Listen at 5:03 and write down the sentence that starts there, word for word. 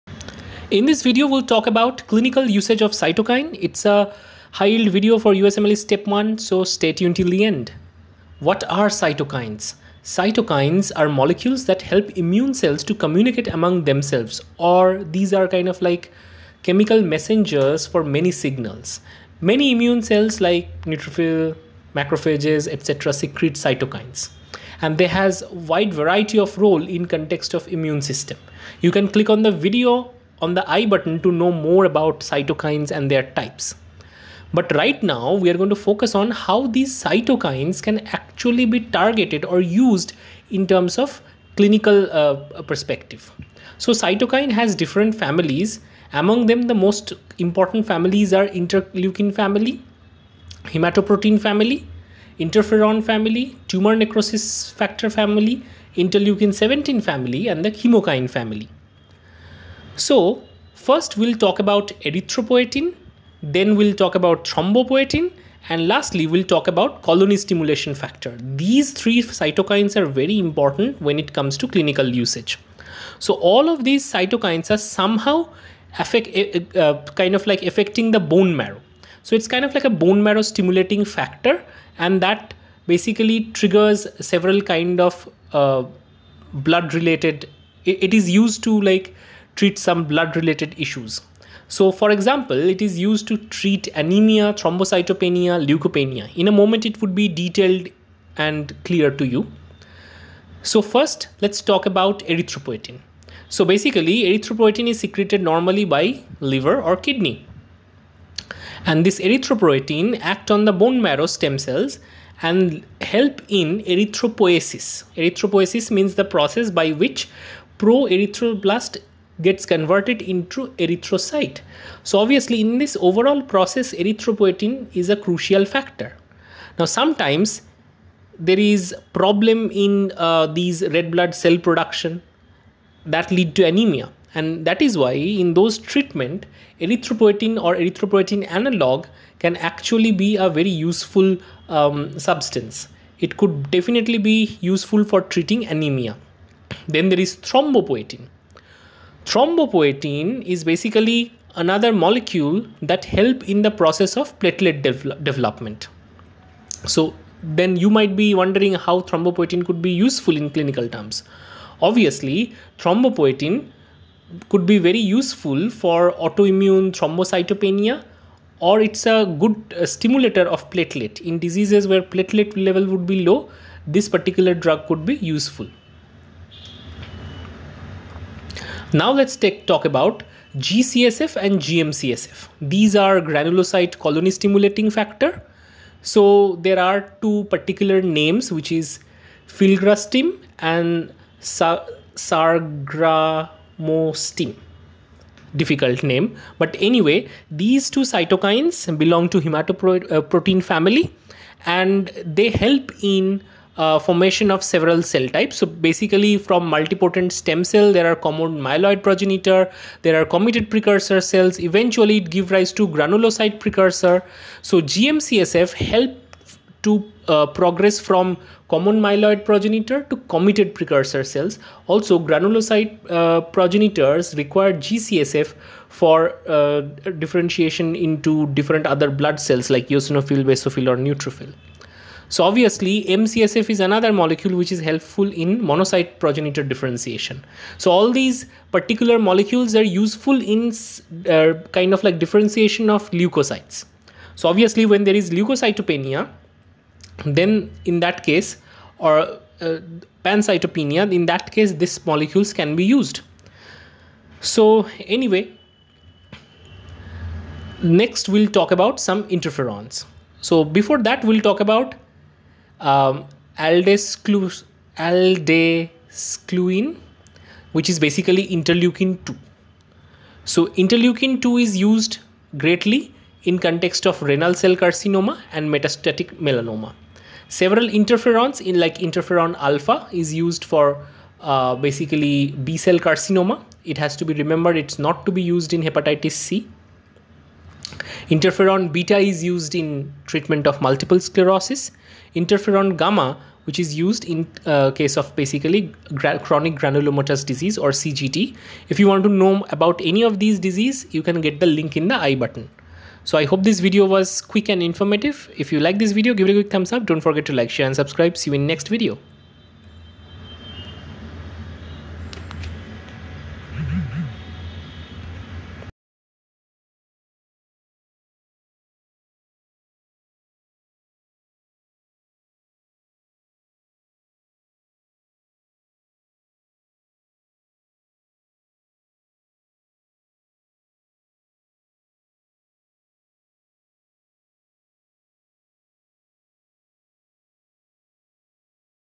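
So I hope this video was quick and informative.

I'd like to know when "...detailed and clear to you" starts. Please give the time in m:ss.
1:37.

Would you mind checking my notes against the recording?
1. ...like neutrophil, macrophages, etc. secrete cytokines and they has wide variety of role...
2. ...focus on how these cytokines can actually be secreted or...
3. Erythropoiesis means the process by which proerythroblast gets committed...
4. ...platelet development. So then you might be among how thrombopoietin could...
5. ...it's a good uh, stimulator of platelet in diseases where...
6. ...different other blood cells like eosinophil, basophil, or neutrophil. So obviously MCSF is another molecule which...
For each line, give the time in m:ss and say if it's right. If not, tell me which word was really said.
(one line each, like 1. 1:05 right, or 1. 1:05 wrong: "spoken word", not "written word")
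1. 0:20 right
2. 0:35 wrong: "targeted", not "secreted"
3. 1:55 wrong: "converted", not "committed"
4. 2:34 wrong: "wondering", not "among"
5. 2:48 right
6. 3:48 right.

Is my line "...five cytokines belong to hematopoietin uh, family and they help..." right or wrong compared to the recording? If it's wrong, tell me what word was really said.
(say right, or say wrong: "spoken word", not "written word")
wrong: "two", not "five".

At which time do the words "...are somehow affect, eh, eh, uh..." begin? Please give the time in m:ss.
1:14.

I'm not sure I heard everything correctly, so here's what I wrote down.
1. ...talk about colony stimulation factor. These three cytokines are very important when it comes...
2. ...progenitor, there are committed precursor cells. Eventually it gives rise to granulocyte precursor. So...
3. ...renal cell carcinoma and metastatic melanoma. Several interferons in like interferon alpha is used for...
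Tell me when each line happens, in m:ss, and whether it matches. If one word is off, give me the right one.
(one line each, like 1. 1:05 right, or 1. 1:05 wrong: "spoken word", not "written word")
1. 1:06 right
2. 3:29 right
3. 4:34 right.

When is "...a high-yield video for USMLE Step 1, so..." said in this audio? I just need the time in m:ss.
0:03.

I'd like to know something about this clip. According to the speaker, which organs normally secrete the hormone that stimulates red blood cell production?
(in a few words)
liver or kidney.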